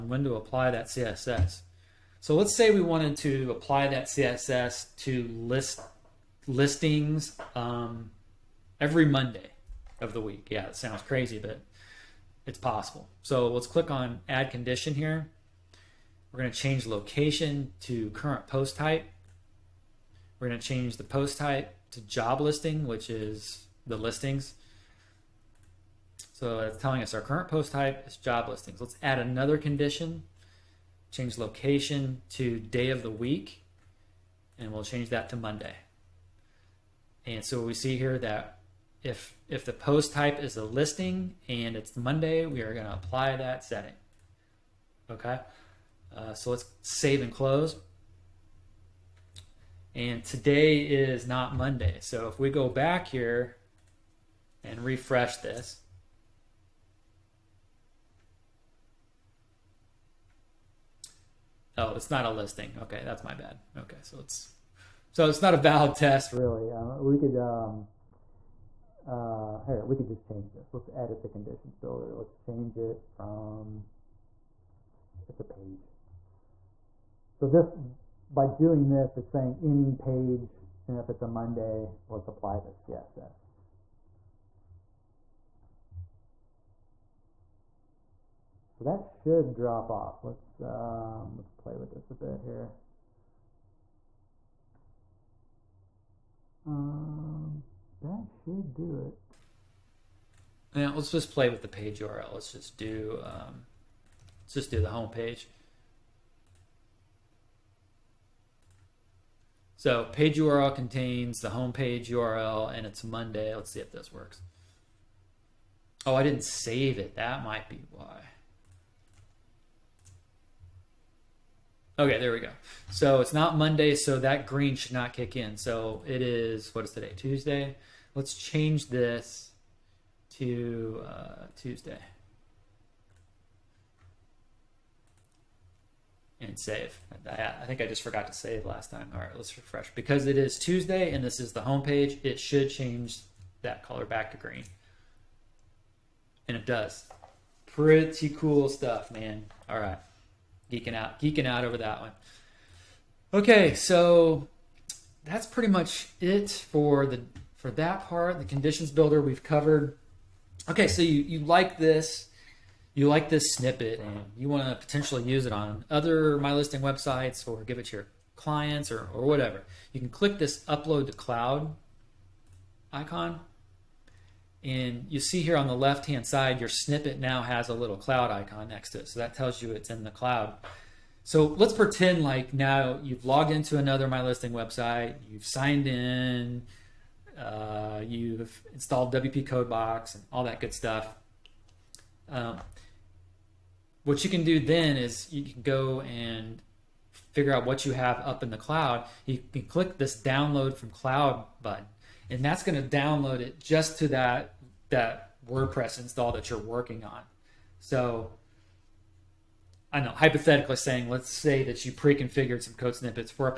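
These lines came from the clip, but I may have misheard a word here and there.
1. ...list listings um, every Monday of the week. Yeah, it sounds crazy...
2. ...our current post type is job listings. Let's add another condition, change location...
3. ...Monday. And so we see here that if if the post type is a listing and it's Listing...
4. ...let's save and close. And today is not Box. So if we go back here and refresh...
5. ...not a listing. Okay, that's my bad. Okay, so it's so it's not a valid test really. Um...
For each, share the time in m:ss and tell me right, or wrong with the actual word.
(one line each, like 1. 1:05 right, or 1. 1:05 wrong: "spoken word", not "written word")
1. 0:05 right
2. 0:27 right
3. 0:35 wrong: "Monday", not "Listing"
4. 0:46 wrong: "Monday", not "Box"
5. 1:02 right.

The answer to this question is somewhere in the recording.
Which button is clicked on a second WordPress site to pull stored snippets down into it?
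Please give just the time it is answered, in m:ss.
3:20.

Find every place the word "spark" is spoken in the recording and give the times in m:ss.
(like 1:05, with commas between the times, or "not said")
not said.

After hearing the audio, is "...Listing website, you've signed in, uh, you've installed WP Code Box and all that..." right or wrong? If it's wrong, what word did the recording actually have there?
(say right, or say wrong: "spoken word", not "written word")
right.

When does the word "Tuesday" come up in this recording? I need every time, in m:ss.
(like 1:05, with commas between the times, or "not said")
2:07, 2:11, 2:20.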